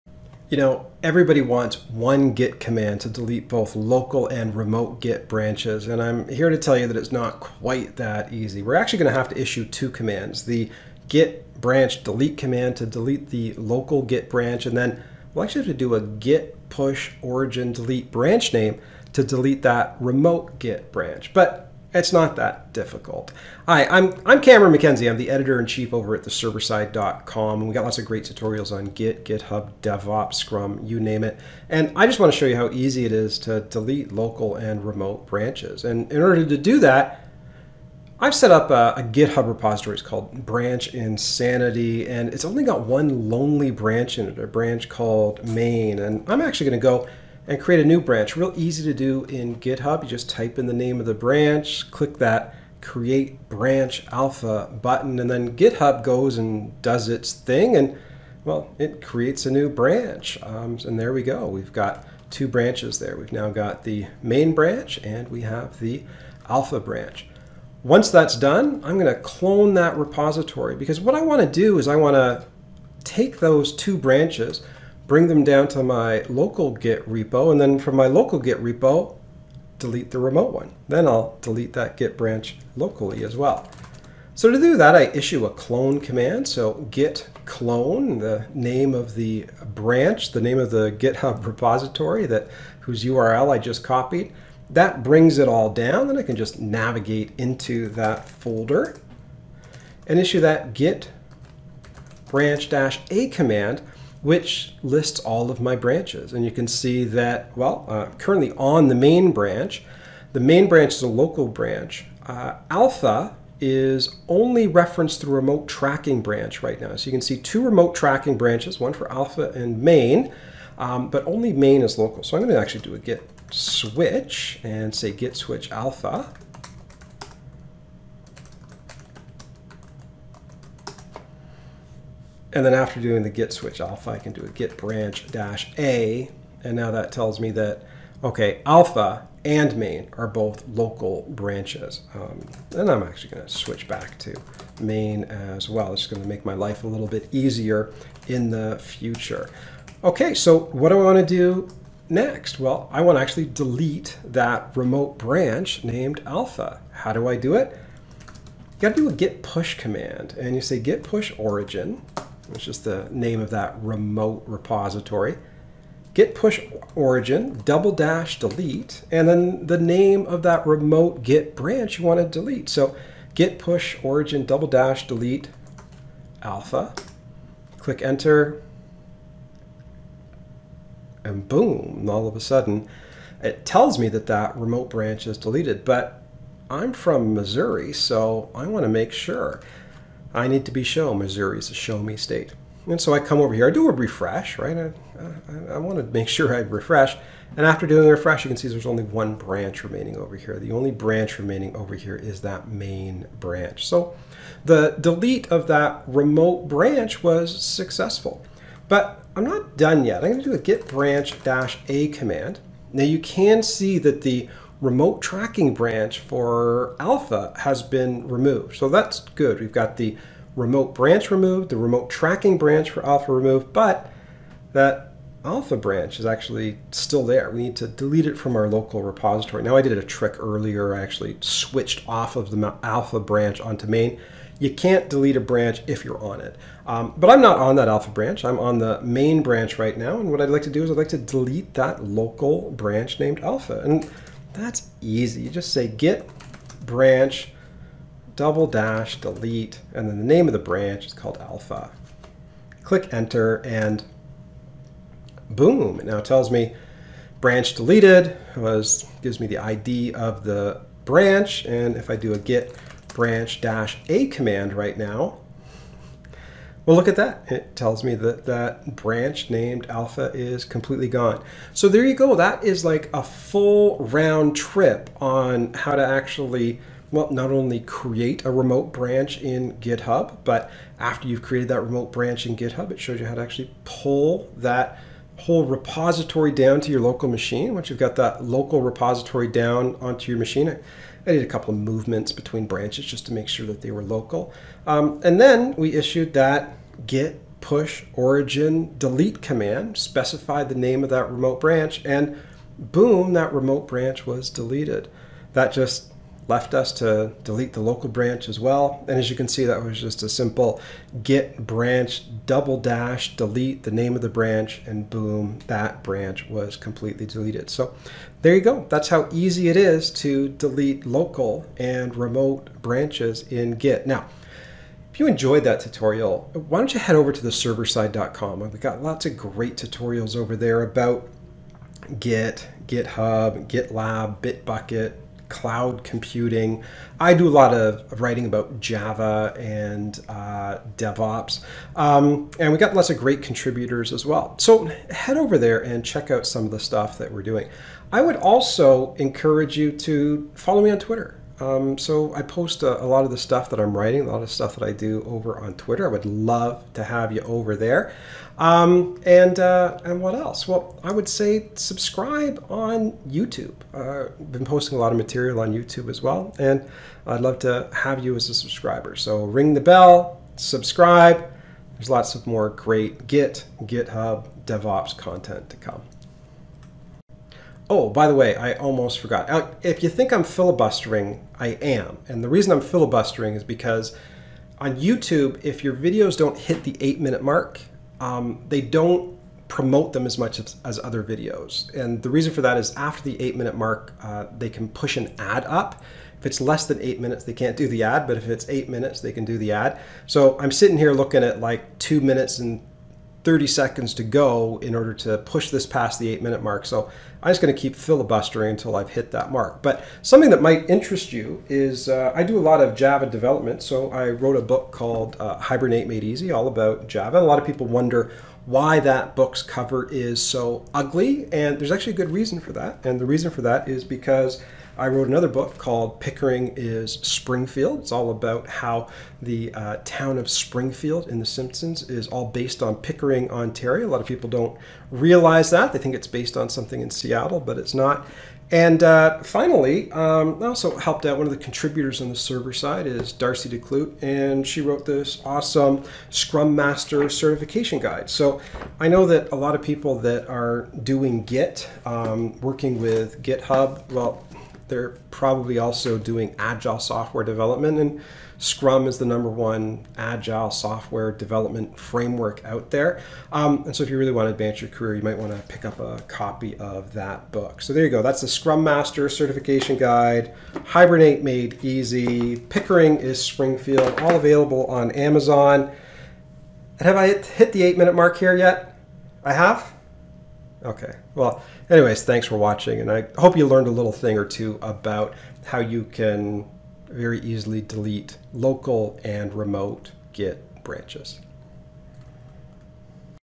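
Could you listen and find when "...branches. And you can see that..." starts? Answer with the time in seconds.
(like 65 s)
105 s.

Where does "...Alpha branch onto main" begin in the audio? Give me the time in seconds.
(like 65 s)
232 s.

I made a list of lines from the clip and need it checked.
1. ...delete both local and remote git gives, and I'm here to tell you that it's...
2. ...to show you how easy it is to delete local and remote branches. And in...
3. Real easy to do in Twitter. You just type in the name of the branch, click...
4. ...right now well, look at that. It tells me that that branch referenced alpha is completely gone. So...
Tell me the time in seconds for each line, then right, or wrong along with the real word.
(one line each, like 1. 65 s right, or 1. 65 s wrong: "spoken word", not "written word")
1. 3 s wrong: "branches", not "gives"
2. 32 s right
3. 48 s wrong: "GitHub", not "Twitter"
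4. 264 s wrong: "named", not "referenced".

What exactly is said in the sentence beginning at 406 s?
So I'm just going to keep filibustering until I've hit that mark.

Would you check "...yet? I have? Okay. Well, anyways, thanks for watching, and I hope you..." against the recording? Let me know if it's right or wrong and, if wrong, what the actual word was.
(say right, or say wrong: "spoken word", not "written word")
right.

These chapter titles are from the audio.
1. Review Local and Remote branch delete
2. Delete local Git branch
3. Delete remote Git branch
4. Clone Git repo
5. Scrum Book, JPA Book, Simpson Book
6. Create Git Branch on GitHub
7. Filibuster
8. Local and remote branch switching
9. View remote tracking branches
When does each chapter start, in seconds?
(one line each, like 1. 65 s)
1. 275 s
2. 240 s
3. 155 s
4. 70 s
5. 370 s
6. 45 s
7. 325 s
8. 120 s
9. 260 s.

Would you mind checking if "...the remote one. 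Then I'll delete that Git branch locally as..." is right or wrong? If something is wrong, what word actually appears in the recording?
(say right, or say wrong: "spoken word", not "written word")
right.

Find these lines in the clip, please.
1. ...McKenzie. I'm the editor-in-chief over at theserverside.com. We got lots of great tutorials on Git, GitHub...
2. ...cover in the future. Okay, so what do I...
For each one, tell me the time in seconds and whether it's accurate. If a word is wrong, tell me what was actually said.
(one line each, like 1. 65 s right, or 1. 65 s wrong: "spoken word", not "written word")
1. 24 s right
2. 147 s wrong: "easier", not "cover".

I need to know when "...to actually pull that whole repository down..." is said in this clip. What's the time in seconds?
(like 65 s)
283 s.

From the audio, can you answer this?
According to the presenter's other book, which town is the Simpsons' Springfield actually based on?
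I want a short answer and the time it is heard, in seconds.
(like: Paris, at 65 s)
Pickering, Ontario, at 432 s.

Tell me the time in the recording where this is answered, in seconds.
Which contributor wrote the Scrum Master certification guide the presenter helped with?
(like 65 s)
443 s.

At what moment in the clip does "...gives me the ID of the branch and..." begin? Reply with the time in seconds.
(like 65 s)
259 s.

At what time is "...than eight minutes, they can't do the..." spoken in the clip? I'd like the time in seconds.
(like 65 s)
396 s.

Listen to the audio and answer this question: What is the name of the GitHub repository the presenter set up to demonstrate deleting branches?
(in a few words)
Branch Insanity.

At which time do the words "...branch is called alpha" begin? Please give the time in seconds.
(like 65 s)
250 s.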